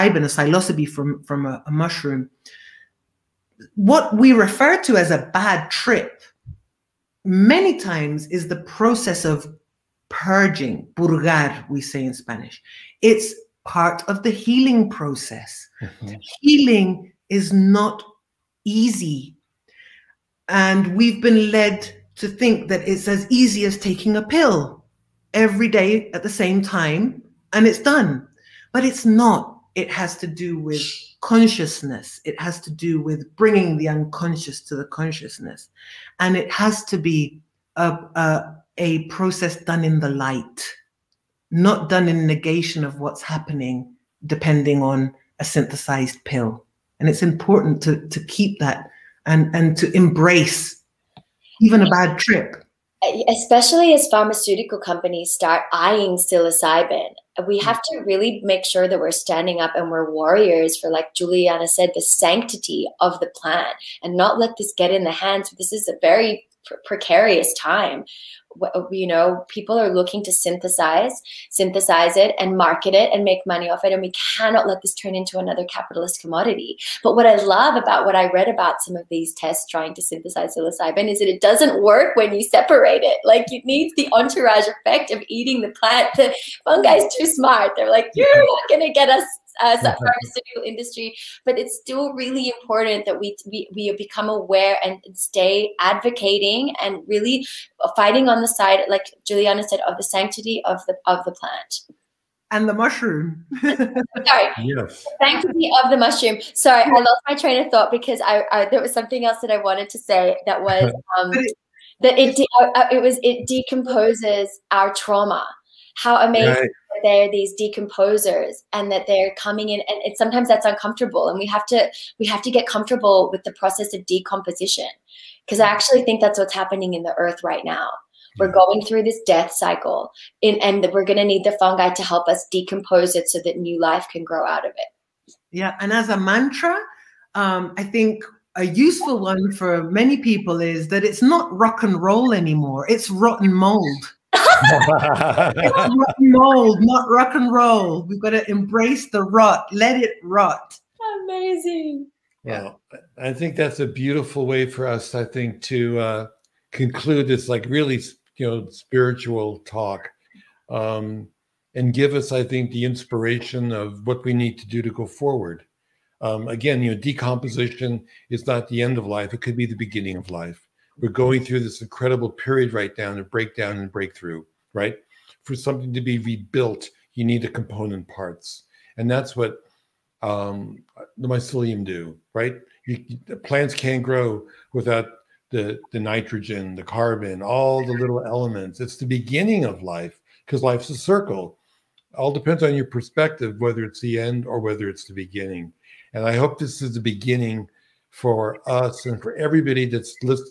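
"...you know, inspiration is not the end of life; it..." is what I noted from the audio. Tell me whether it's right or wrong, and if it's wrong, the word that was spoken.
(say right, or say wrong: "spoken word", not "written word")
wrong: "decomposition", not "inspiration".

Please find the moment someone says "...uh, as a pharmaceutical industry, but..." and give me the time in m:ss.
1:29.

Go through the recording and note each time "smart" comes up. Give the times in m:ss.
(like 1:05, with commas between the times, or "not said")
1:27.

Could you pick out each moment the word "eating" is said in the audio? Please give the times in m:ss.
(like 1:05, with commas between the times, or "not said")
1:25.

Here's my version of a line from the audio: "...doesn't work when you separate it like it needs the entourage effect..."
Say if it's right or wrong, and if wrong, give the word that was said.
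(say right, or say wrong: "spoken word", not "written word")
right.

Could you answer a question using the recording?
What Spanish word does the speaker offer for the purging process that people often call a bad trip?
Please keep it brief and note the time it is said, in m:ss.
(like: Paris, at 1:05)
purgar, at 0:10.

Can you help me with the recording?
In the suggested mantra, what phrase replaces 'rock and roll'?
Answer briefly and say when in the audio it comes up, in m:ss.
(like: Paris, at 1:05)
rotten mold, at 2:23.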